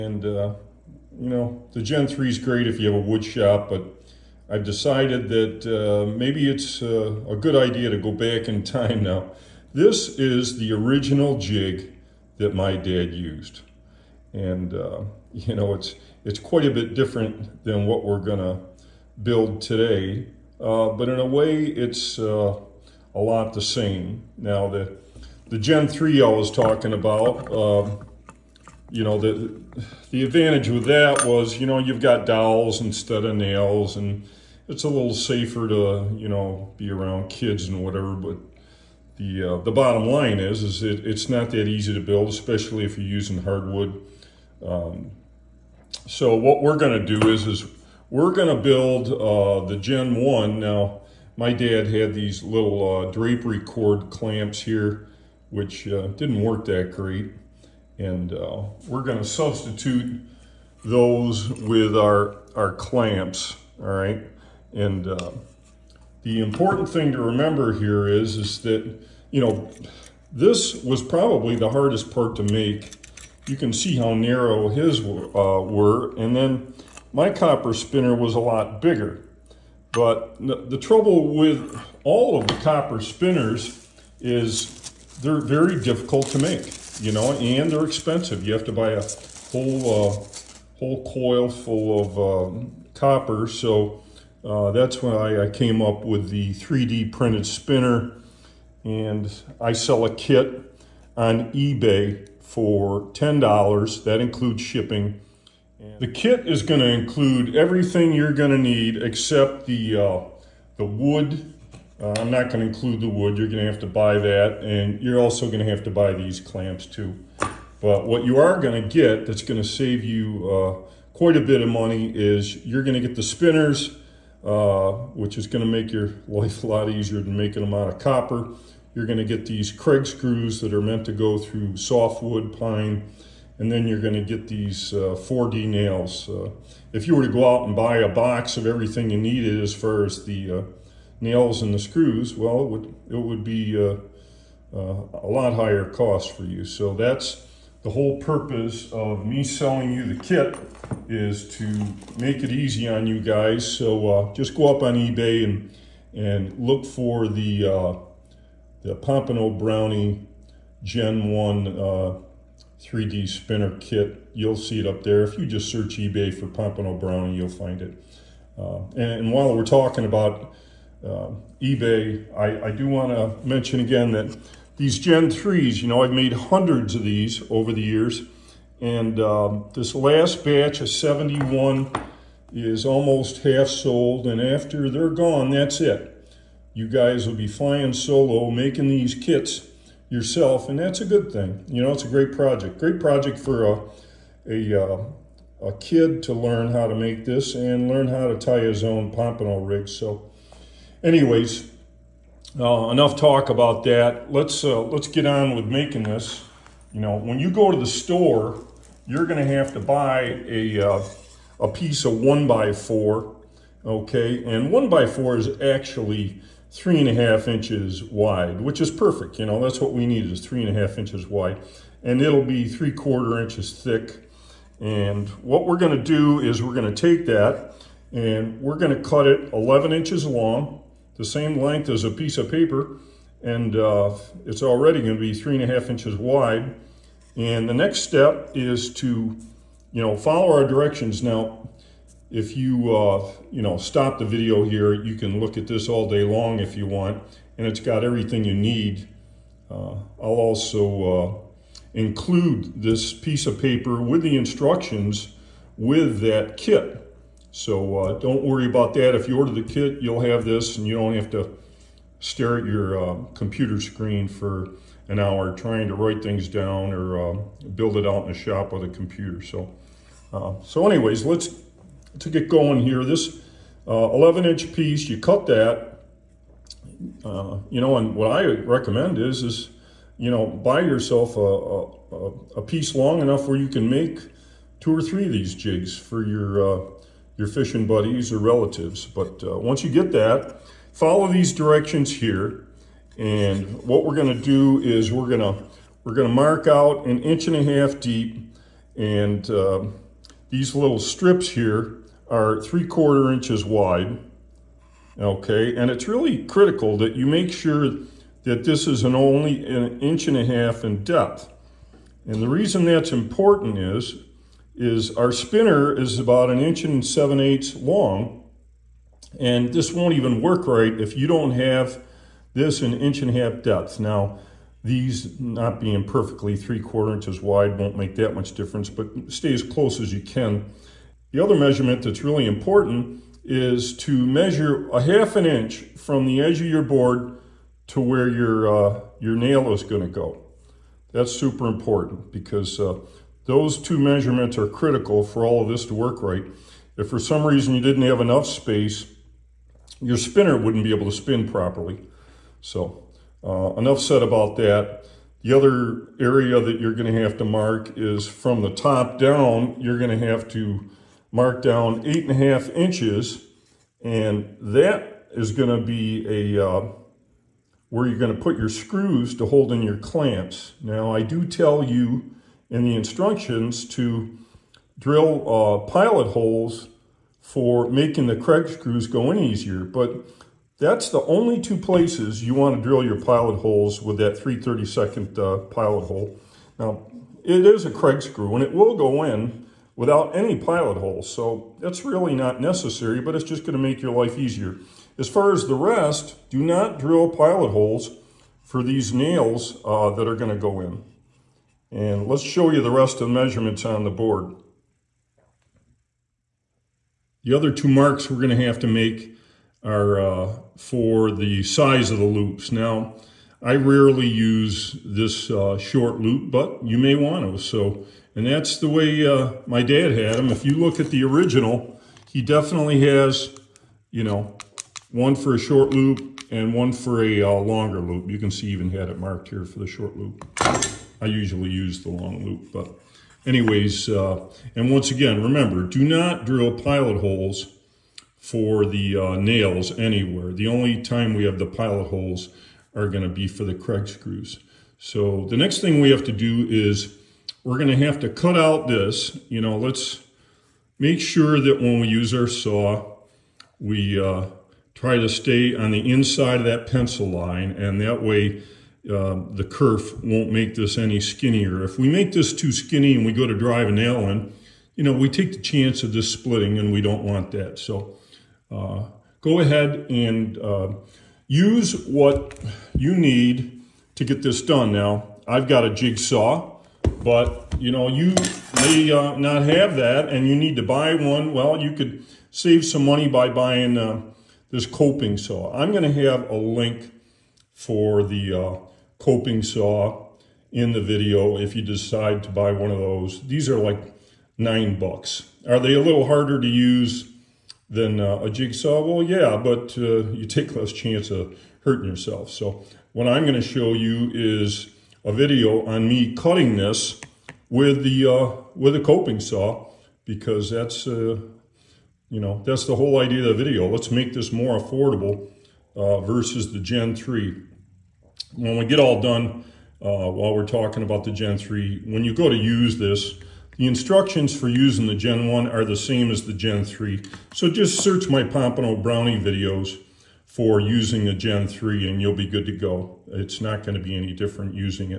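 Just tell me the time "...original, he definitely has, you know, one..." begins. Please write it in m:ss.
7:01.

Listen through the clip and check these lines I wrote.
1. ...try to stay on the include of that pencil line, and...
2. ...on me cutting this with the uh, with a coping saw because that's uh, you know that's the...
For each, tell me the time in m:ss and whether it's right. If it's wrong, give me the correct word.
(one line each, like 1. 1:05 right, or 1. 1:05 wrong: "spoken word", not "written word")
1. 7:34 wrong: "inside", not "include"
2. 8:25 right.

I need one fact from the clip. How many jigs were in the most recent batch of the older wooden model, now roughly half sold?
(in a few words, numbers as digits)
71.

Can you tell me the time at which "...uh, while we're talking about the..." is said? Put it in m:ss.
8:40.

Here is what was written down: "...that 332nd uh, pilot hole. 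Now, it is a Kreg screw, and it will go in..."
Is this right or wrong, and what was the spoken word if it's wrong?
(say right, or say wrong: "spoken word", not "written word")
right.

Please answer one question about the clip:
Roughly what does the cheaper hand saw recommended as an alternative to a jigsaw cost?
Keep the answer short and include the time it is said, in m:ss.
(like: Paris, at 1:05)
$9, at 8:14.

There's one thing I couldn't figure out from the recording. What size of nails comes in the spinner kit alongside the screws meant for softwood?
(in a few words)
4D.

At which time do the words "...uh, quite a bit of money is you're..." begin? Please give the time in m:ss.
2:00.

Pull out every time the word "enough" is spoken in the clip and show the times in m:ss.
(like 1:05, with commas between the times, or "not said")
3:22, 4:43, 5:48, 5:53.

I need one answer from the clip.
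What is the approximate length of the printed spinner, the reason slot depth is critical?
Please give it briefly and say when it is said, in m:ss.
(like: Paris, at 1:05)
1 7/8 inches, at 5:16.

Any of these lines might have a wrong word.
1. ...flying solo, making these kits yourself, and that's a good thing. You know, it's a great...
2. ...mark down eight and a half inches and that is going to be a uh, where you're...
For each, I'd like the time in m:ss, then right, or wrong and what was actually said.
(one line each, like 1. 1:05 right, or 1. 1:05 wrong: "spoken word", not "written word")
1. 3:07 right
2. 6:01 right.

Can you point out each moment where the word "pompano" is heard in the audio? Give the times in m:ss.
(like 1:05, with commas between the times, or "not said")
2:38, 2:46, 3:19, 8:48.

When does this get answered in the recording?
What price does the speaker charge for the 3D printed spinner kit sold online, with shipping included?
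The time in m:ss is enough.
1:43.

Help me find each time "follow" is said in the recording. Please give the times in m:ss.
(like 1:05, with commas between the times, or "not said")
4:00, 4:50.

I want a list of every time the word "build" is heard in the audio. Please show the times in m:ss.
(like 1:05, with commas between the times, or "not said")
0:19, 0:42, 0:48, 4:27.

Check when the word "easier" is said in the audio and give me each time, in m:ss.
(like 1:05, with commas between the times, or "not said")
2:06, 6:19, 6:34.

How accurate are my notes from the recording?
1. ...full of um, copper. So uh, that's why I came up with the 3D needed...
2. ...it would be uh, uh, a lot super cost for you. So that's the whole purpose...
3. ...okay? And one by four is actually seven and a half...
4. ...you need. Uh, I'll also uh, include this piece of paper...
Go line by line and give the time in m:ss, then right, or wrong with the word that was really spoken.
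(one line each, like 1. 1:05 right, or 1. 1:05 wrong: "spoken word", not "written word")
1. 1:31 wrong: "printed", not "needed"
2. 2:23 wrong: "higher", not "super"
3. 3:33 wrong: "three", not "seven"
4. 4:08 right.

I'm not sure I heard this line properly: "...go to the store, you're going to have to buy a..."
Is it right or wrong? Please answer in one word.
right.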